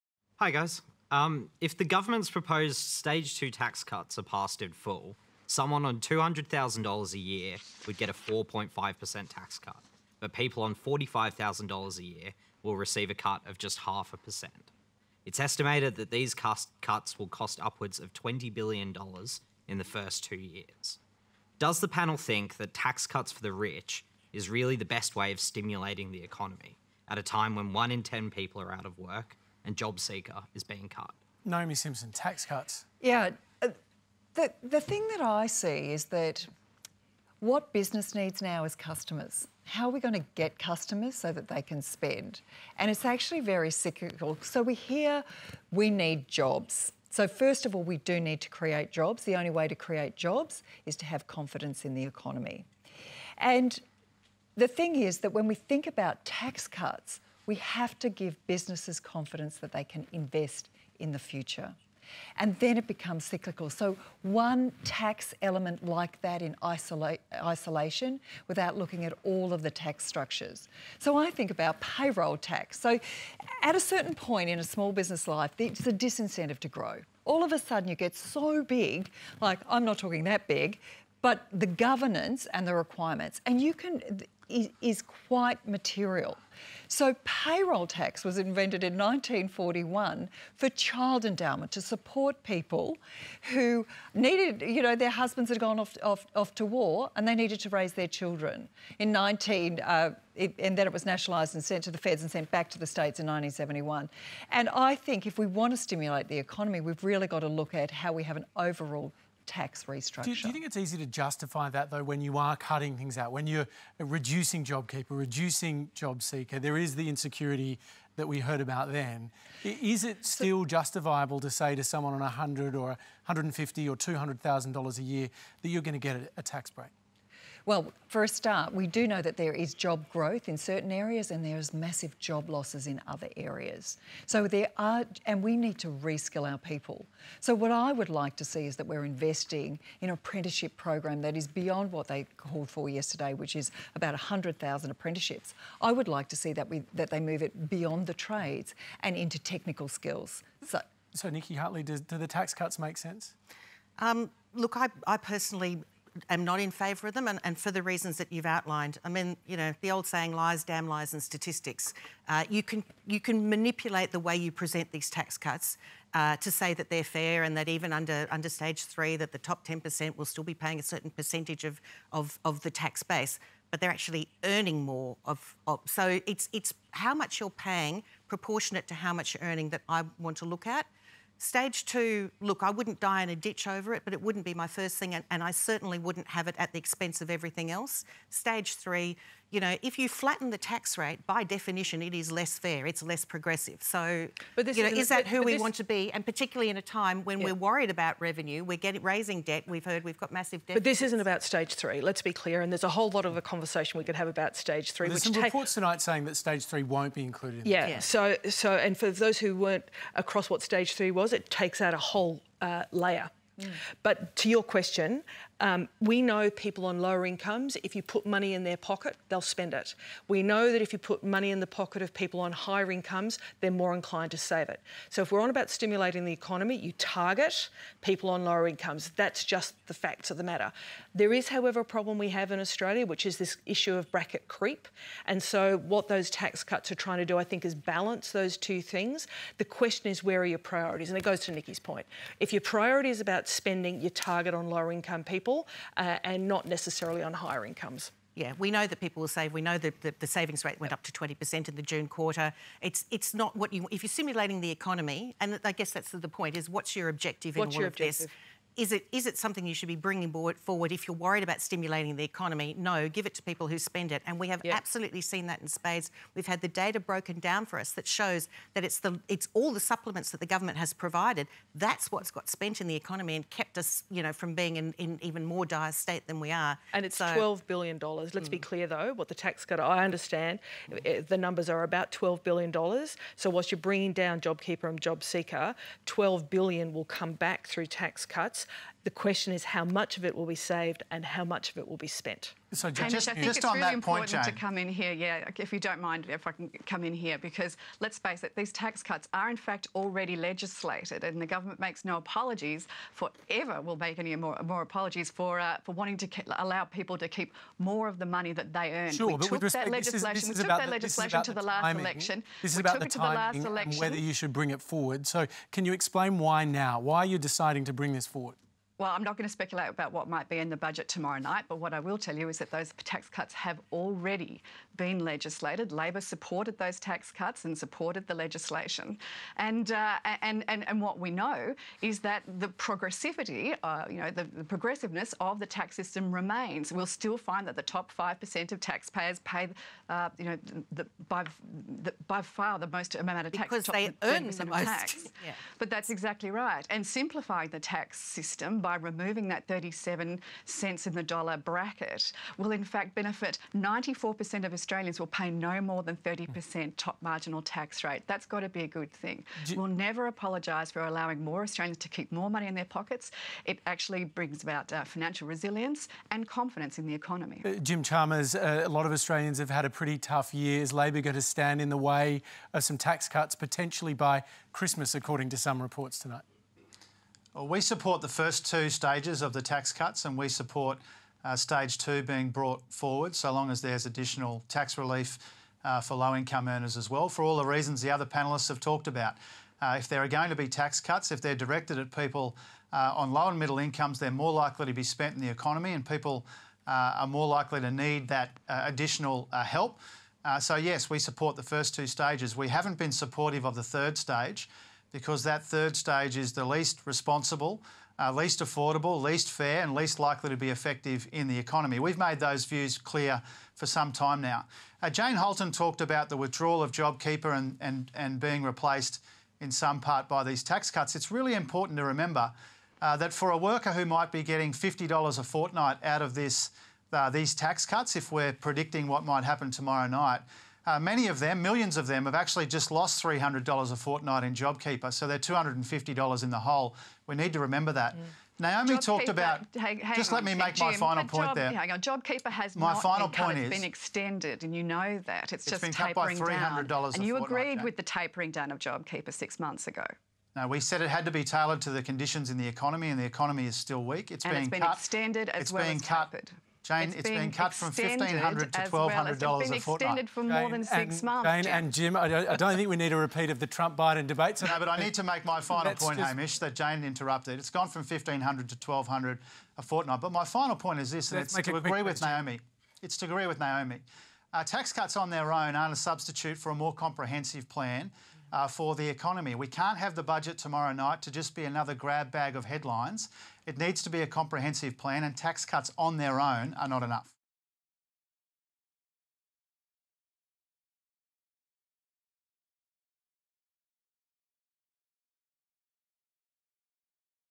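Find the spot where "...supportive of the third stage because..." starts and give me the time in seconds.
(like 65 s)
403 s.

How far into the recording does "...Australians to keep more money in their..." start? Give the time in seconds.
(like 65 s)
361 s.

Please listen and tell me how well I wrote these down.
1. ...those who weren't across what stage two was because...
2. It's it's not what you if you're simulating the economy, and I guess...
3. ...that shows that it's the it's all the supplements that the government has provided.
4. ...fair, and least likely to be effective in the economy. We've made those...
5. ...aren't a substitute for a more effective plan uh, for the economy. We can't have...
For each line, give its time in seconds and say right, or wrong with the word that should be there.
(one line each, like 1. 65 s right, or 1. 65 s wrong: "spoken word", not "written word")
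1. 209 s wrong: "three", not "two"
2. 252 s right
3. 267 s right
4. 409 s right
5. 475 s wrong: "comprehensive", not "effective".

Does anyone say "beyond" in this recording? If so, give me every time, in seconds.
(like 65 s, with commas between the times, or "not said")
141 s, 147 s.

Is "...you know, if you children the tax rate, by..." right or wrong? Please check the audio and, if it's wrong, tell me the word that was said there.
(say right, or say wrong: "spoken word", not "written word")
wrong: "flatten", not "children".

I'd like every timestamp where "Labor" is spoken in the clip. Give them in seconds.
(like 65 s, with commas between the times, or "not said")
325 s, 370 s.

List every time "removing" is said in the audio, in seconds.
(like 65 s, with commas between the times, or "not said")
348 s.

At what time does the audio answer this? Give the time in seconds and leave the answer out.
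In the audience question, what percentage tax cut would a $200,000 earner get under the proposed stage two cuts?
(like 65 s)
8 s.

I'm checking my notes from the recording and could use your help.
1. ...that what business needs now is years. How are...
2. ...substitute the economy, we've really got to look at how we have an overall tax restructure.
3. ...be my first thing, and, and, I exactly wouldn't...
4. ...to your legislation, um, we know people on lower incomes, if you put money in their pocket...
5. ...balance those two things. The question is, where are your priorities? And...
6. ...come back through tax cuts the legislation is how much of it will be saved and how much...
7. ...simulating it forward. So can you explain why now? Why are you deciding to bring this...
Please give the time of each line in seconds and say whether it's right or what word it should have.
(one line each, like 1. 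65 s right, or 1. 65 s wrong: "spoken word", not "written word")
1. 36 s wrong: "customers", not "years"
2. 105 s wrong: "stimulate", not "substitute"
3. 184 s wrong: "certainly", not "exactly"
4. 214 s wrong: "question", not "legislation"
5. 237 s right
6. 287 s wrong: "question", not "legislation"
7. 314 s wrong: "bring", not "simulating".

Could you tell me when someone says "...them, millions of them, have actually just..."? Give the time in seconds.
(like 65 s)
431 s.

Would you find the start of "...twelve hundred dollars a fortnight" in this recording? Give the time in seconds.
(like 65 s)
458 s.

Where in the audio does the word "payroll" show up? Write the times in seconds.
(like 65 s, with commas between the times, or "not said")
71 s, 87 s.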